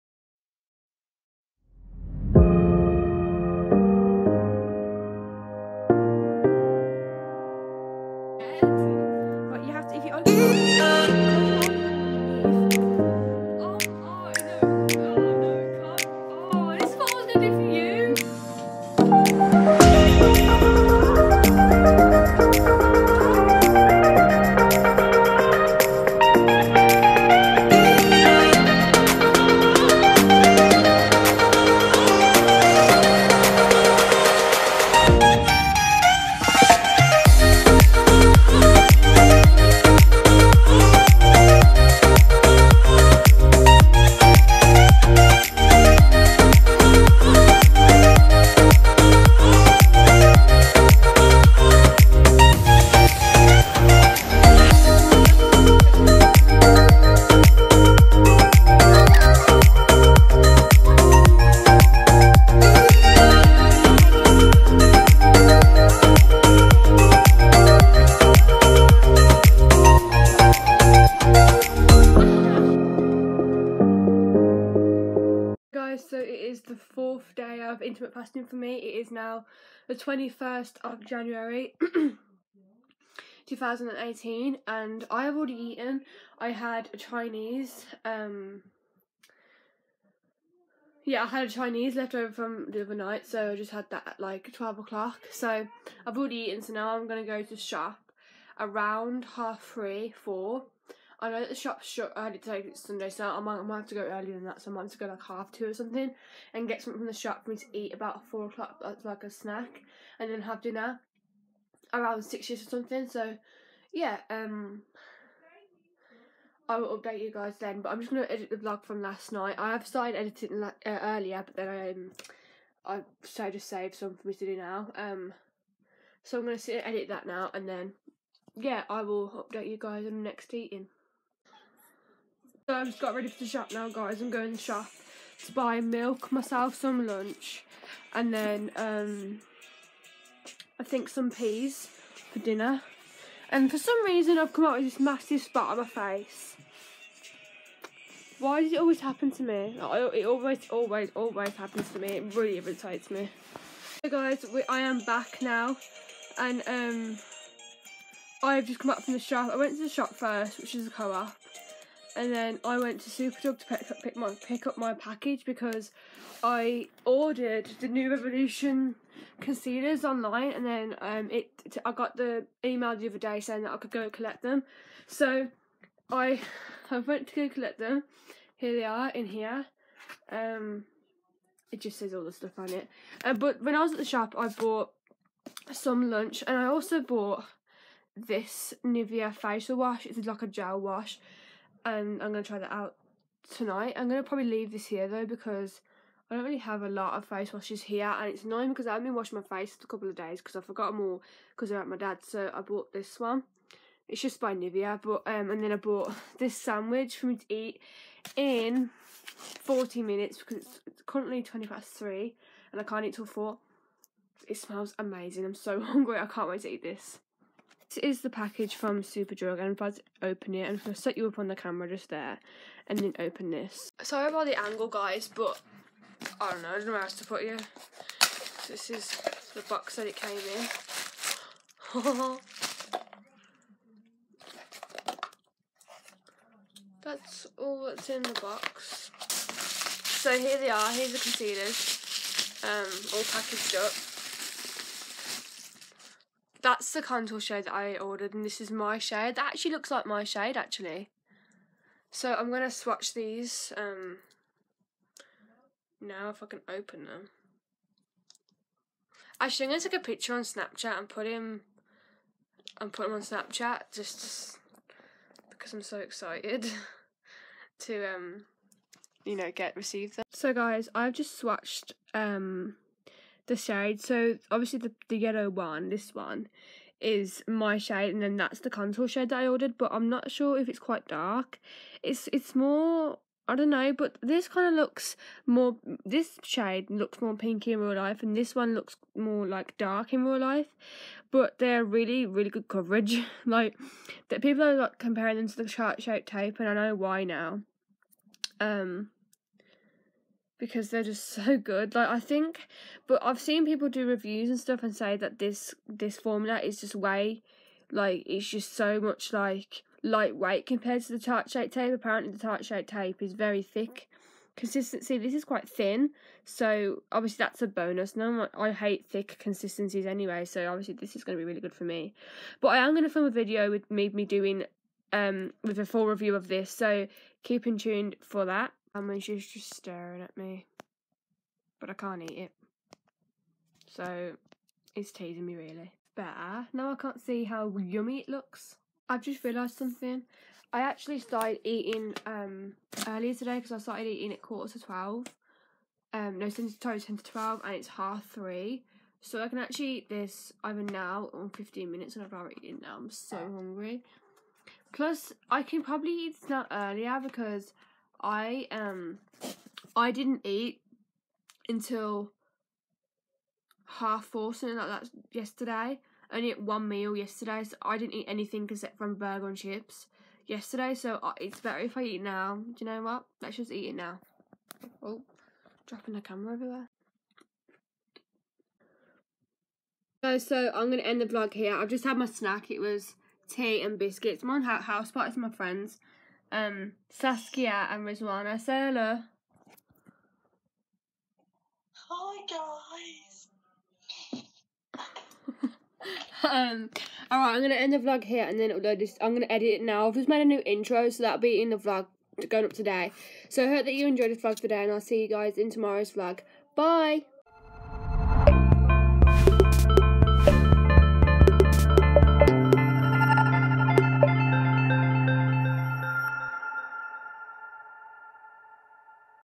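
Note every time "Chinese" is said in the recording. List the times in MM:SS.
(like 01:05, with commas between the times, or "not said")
01:26, 01:31.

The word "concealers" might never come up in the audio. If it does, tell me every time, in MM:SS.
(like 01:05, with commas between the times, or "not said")
02:49, 04:01.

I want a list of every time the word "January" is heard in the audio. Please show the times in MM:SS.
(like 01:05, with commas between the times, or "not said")
01:21.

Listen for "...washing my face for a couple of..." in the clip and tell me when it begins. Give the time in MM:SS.
03:19.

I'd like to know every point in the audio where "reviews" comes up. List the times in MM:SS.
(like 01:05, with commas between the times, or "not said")
05:04, 05:26.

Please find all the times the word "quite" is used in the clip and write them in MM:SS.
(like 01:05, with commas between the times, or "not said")
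04:40, 05:15.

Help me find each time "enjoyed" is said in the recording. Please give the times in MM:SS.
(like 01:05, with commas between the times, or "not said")
06:44.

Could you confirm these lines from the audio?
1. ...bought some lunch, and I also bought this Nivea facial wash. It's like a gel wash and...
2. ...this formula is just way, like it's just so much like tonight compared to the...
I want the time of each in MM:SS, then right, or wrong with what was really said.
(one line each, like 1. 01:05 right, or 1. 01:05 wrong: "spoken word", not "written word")
1. 03:04 right
2. 05:05 wrong: "lightweight", not "tonight".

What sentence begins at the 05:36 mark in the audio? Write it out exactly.
But uh, now I can't see how yummy it looks.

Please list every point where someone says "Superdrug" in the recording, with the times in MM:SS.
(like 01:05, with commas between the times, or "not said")
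02:43, 03:39.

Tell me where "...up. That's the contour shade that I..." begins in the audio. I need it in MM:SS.
04:03.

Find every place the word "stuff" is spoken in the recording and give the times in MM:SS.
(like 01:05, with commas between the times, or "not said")
03:02, 05:04.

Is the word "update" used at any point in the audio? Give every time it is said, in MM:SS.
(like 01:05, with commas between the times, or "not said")
01:56, 02:09.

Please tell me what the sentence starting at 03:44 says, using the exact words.
Sorry about the angle, guys, but I don't know.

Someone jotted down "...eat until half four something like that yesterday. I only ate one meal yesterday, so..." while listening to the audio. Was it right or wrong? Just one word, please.
right.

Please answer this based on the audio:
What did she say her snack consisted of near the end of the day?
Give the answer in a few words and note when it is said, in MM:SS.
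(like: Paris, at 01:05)
Tea and biscuits, at 06:23.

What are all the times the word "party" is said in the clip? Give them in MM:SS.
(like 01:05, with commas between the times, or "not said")
06:25.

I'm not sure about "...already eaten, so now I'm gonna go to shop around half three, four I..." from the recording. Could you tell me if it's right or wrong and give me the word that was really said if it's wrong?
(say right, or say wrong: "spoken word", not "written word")
right.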